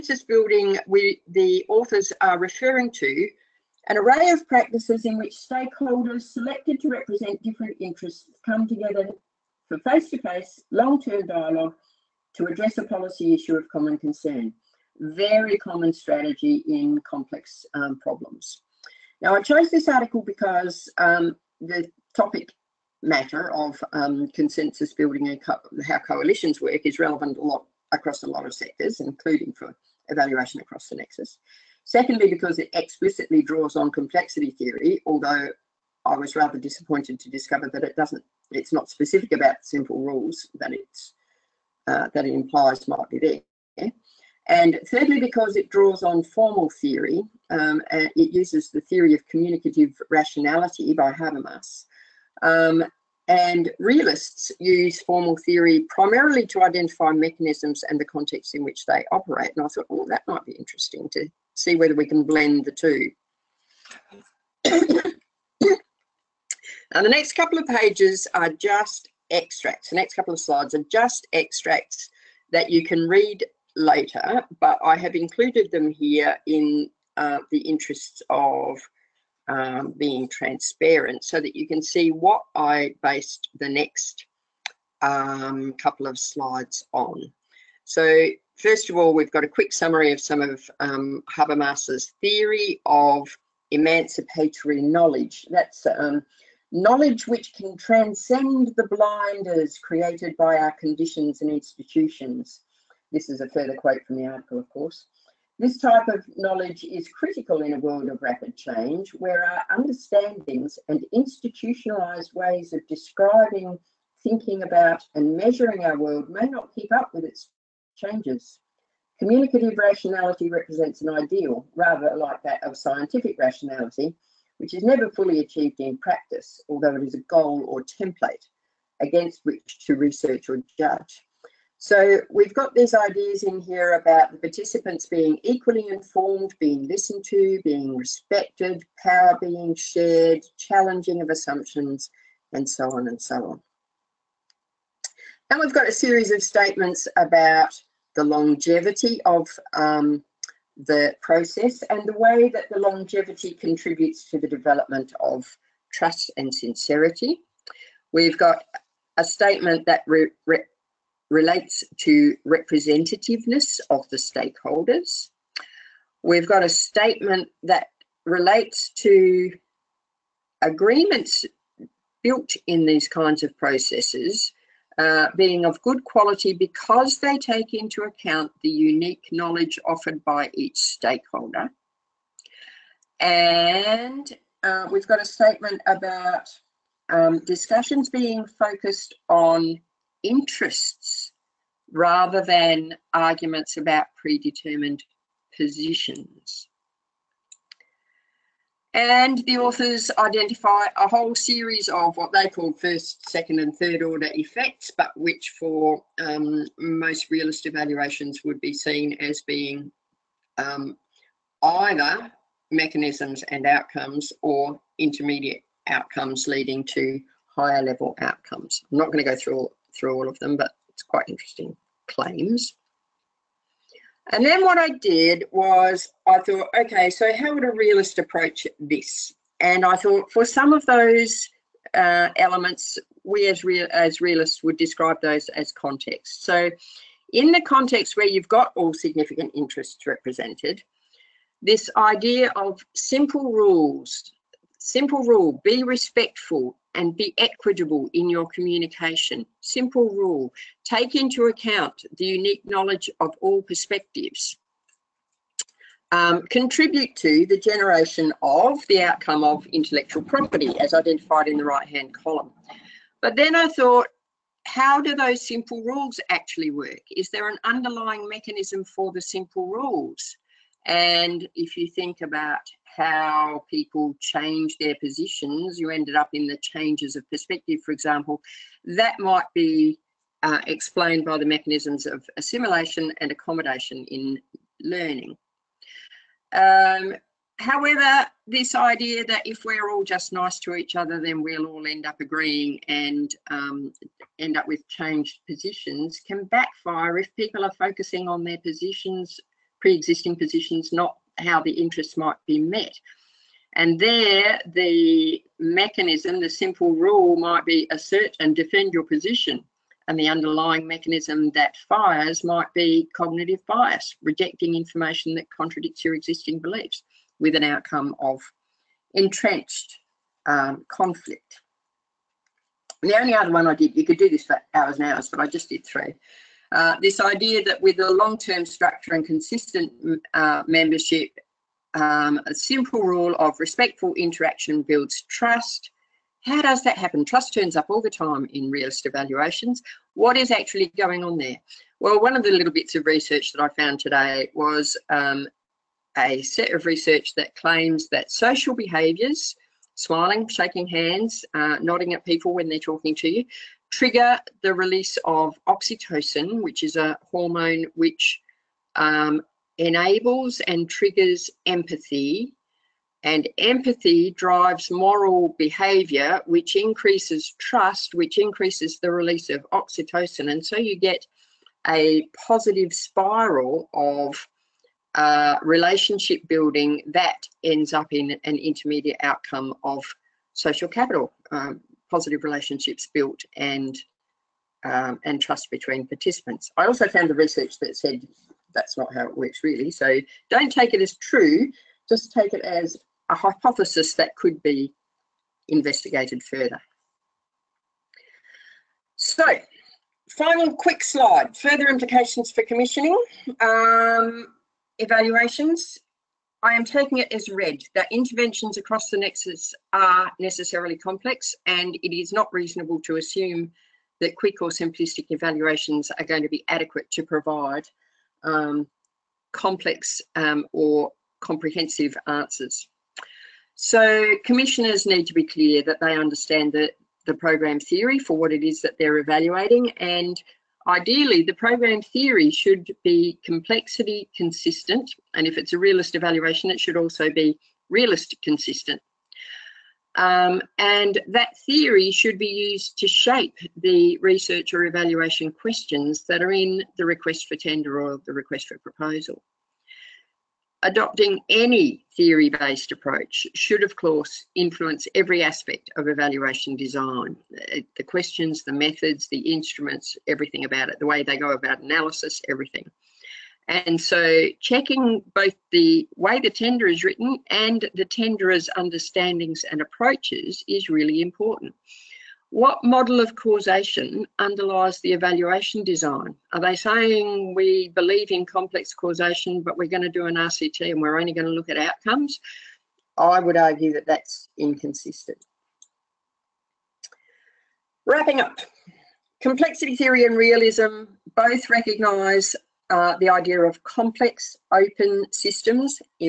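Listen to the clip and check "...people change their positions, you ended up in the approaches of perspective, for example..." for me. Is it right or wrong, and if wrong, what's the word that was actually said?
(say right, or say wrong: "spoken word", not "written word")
wrong: "changes", not "approaches".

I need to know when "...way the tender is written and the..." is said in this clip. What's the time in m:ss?
7:46.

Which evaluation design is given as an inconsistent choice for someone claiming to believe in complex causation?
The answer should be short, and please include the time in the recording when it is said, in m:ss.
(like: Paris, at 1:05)
RCT, at 8:00.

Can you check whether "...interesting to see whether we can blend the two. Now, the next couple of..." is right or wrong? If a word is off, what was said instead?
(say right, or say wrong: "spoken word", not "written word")
right.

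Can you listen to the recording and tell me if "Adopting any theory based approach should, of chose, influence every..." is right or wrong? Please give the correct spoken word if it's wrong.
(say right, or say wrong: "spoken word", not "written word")
wrong: "course", not "chose".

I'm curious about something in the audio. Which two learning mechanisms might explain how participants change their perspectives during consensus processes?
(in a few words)
assimilation and accommodation.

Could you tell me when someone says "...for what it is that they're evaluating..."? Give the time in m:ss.
7:08.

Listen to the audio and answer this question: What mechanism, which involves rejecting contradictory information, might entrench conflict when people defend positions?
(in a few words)
cognitive bias.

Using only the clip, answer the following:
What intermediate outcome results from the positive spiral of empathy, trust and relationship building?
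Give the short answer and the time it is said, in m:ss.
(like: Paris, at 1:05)
social capital, at 6:20.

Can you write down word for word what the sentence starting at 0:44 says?
And thirdly, because it draws on formal theory, um, and it uses the theory of communicative rationality by Habermas.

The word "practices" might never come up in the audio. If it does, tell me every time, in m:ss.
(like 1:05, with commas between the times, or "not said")
0:04, 2:05.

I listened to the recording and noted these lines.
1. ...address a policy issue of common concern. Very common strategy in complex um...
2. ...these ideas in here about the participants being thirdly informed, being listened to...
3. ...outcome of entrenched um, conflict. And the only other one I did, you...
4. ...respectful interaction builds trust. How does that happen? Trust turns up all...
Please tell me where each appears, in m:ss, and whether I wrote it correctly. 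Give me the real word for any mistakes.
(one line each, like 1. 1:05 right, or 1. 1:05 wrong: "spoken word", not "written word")
1. 0:12 right
2. 2:12 wrong: "equally", not "thirdly"
3. 5:17 right
4. 5:33 right.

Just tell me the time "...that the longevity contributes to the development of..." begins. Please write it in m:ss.
2:32.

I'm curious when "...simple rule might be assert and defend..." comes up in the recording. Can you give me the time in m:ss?
5:06.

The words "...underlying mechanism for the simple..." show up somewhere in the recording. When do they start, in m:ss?
4:27.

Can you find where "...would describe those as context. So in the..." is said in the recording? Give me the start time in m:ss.
3:54.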